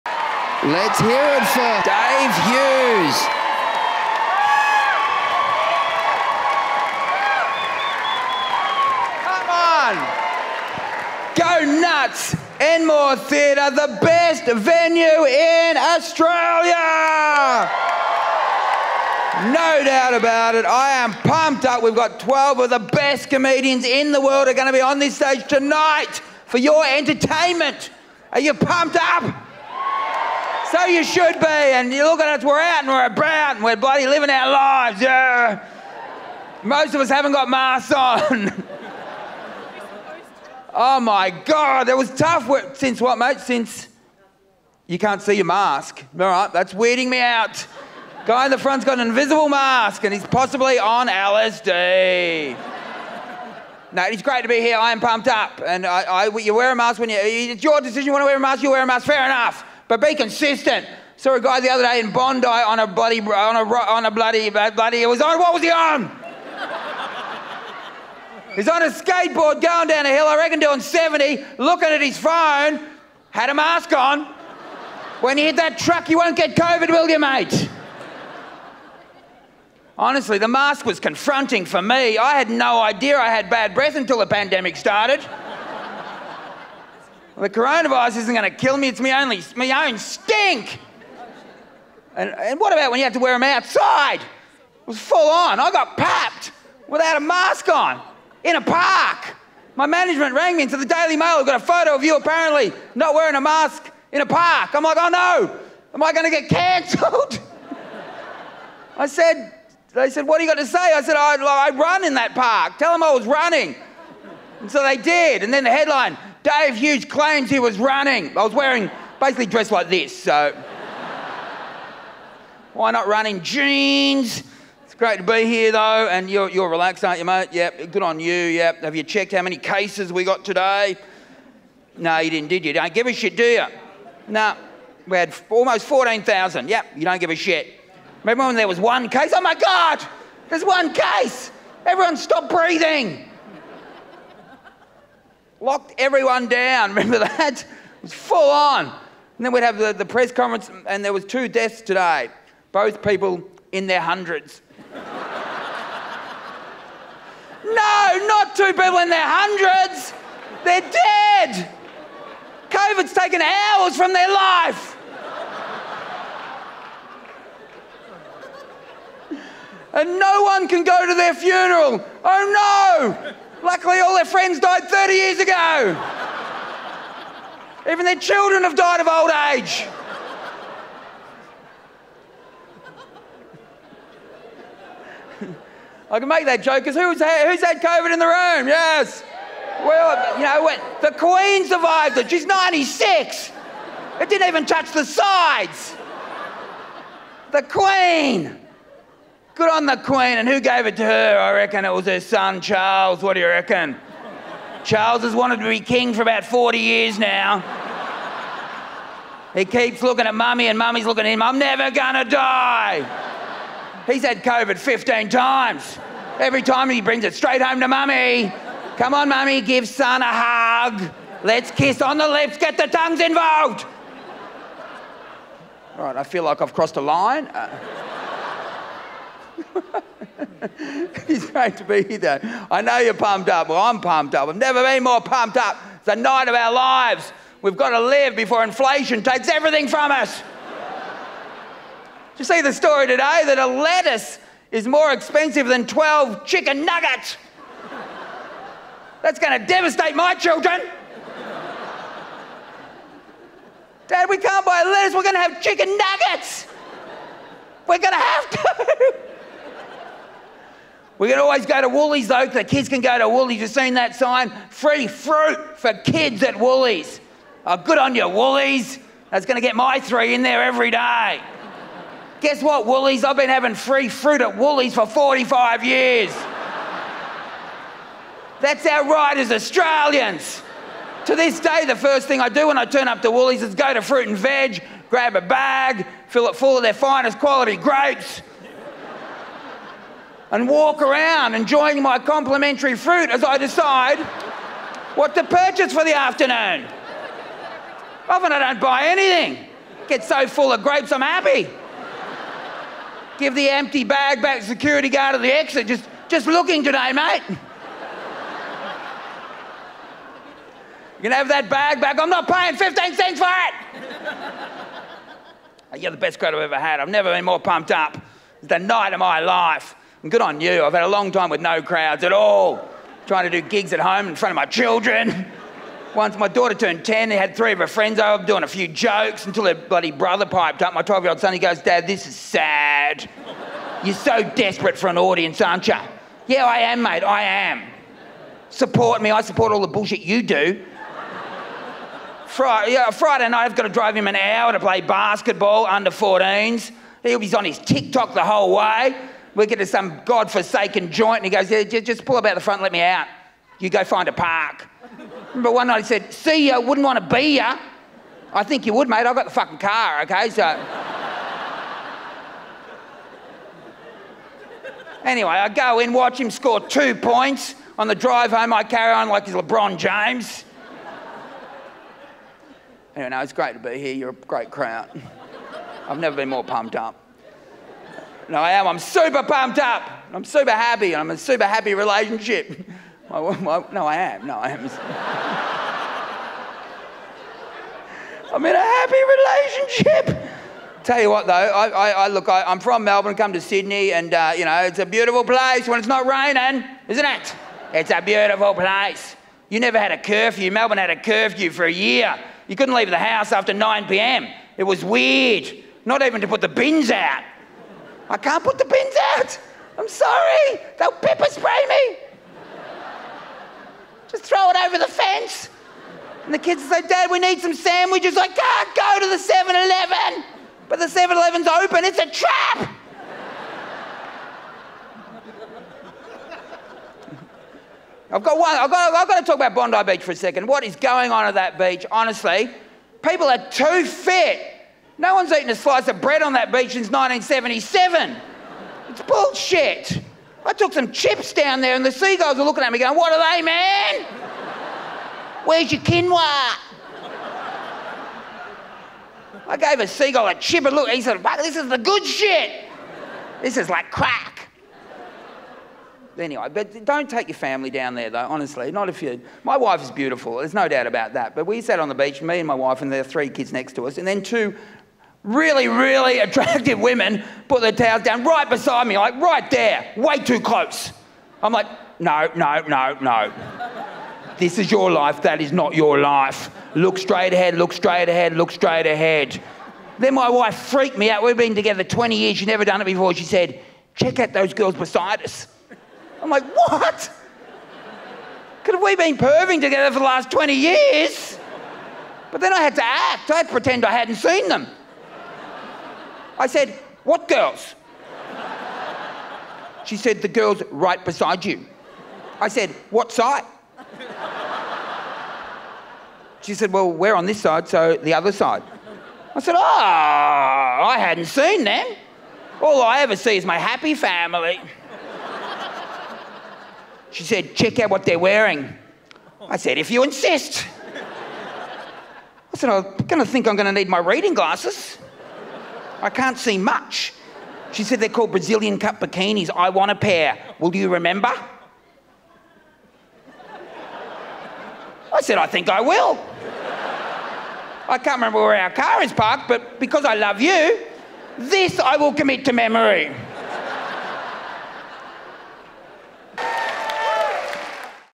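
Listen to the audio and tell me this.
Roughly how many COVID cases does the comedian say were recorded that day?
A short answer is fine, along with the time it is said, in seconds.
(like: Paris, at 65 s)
14,000, at 135 s.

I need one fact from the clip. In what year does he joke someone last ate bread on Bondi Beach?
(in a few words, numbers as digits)
1977.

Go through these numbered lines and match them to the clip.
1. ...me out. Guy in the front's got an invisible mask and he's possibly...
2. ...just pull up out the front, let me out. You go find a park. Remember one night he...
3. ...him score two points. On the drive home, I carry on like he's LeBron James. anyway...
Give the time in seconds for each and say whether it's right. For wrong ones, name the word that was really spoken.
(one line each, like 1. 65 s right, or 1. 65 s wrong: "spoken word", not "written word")
1. 47 s right
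2. 351 s right
3. 366 s right.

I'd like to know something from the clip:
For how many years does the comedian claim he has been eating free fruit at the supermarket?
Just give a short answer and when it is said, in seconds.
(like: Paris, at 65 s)
45, at 275 s.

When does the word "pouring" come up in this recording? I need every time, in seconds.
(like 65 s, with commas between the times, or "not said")
not said.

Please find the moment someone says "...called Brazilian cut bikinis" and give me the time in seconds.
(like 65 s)
528 s.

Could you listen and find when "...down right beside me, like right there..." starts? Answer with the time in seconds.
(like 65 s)
468 s.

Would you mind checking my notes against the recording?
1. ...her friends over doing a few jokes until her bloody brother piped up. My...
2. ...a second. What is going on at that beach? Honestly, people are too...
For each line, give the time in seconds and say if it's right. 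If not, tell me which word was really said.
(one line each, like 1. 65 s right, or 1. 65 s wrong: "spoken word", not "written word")
1. 327 s right
2. 430 s right.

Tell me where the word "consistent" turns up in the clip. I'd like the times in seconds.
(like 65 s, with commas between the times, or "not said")
60 s.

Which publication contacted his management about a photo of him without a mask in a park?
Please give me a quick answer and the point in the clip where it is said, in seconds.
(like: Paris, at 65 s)
Daily Mail, at 100 s.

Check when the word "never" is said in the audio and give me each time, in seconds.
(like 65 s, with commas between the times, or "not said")
211 s, 234 s, 317 s, 376 s, 399 s, 482 s.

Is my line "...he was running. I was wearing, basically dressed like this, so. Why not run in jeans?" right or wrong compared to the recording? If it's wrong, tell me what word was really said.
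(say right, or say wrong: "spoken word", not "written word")
right.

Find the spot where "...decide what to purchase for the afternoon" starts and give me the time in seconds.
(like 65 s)
293 s.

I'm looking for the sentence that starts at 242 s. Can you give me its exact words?
Did you see the story today that a lettuce is more expensive than 12 chicken nuggets?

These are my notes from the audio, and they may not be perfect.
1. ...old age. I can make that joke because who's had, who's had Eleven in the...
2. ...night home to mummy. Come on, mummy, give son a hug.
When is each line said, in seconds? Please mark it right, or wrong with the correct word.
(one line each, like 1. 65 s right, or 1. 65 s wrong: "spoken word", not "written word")
1. 179 s wrong: "COVID", not "Eleven"
2. 217 s wrong: "straight", not "night".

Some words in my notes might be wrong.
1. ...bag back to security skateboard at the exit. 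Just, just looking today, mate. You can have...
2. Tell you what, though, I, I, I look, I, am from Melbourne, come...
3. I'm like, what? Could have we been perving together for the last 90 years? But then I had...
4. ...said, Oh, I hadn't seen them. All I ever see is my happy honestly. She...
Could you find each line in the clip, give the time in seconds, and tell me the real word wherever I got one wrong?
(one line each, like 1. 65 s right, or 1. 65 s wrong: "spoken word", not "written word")
1. 304 s wrong: "guard", not "skateboard"
2. 391 s right
3. 486 s wrong: "20", not "90"
4. 509 s wrong: "family", not "honestly".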